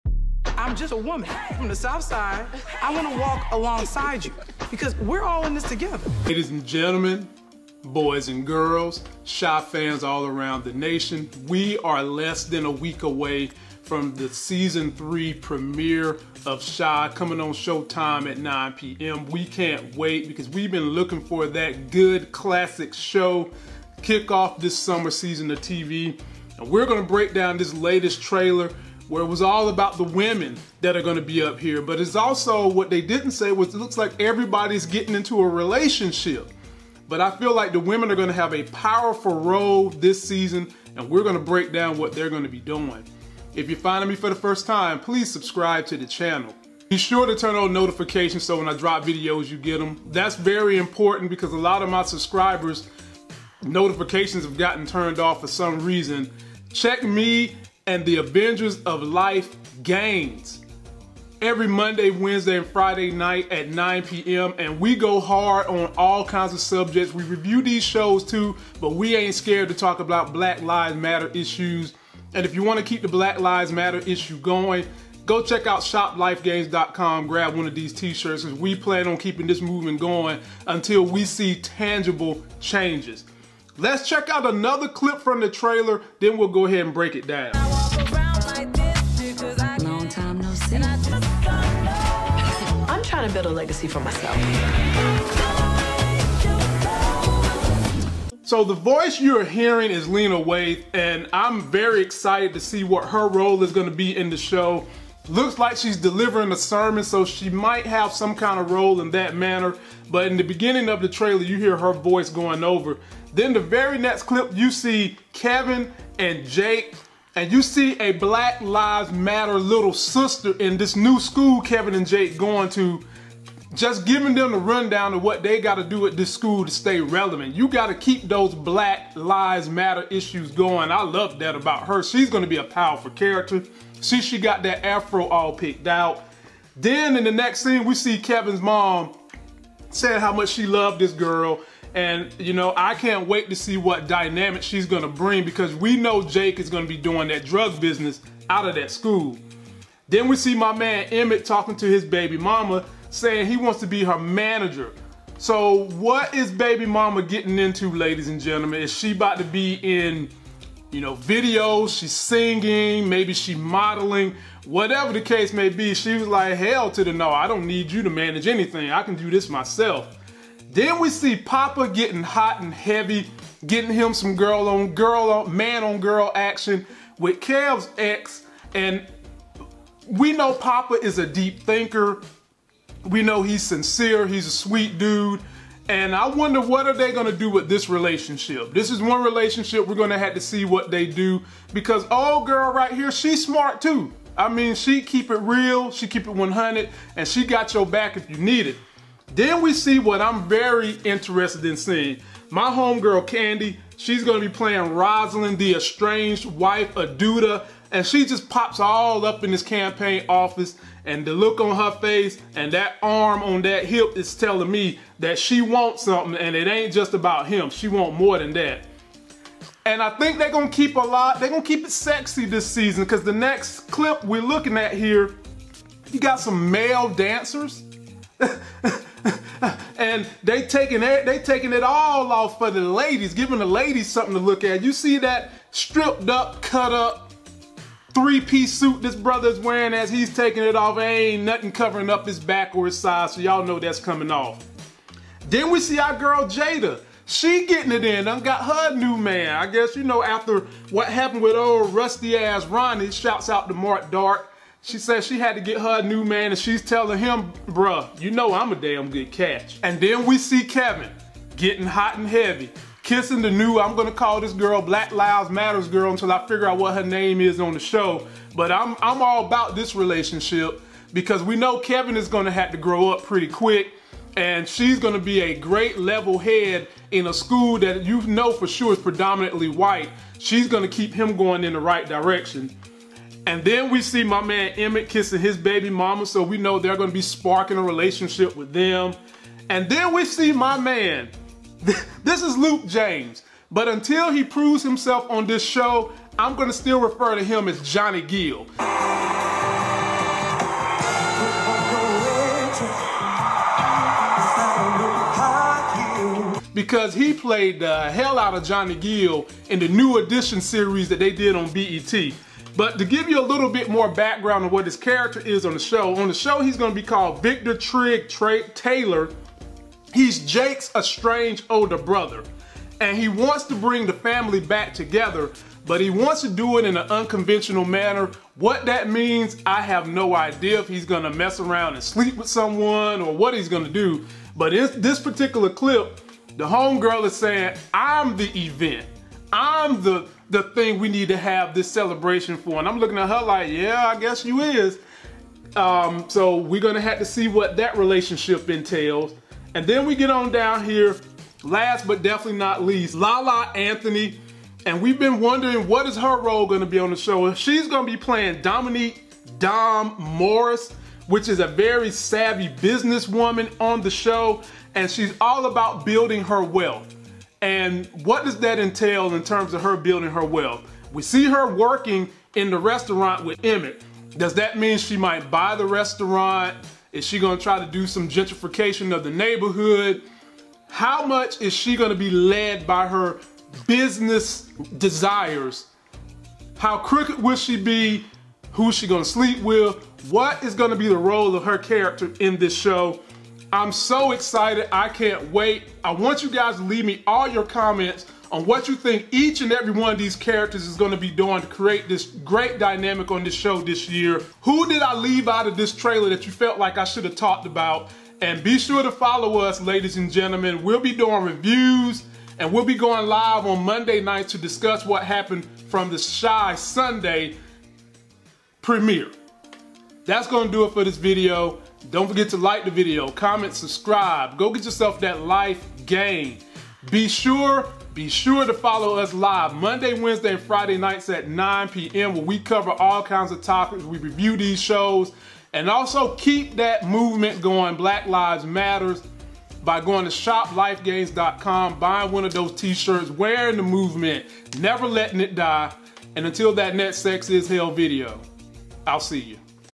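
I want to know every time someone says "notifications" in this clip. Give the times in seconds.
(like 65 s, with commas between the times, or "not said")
47 s, 53 s.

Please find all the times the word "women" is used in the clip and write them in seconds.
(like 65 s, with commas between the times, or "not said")
30 s, 37 s.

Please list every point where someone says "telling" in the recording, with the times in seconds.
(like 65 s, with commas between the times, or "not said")
214 s, 256 s.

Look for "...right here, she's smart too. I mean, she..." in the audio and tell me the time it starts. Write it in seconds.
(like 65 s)
192 s.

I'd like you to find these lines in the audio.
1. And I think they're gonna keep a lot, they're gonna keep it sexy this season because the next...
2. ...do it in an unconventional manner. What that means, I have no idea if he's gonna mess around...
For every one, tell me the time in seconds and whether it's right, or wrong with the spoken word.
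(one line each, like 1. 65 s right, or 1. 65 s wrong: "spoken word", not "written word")
1. 219 s right
2. 326 s right.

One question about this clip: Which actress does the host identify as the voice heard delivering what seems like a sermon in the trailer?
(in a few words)
Lena Waithe.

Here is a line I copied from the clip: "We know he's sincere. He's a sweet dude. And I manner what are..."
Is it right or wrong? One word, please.
wrong.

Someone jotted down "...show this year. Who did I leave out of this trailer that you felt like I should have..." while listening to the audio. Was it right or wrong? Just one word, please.
right.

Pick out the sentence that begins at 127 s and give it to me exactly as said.
You got to keep those Black Lives Matter issues going.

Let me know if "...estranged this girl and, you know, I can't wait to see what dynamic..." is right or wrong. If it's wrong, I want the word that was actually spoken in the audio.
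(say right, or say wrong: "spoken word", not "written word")
wrong: "loved", not "estranged".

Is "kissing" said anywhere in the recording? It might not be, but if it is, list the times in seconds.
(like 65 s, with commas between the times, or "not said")
263 s, 285 s.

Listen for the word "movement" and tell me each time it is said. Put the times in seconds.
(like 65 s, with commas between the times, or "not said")
79 s, 437 s, 443 s.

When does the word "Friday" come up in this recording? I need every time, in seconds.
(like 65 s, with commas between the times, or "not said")
62 s, 430 s.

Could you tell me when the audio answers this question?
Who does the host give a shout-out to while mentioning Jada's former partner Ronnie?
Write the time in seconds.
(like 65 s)
253 s.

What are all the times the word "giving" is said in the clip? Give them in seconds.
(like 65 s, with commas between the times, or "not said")
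124 s, 233 s.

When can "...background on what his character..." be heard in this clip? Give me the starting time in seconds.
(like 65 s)
314 s.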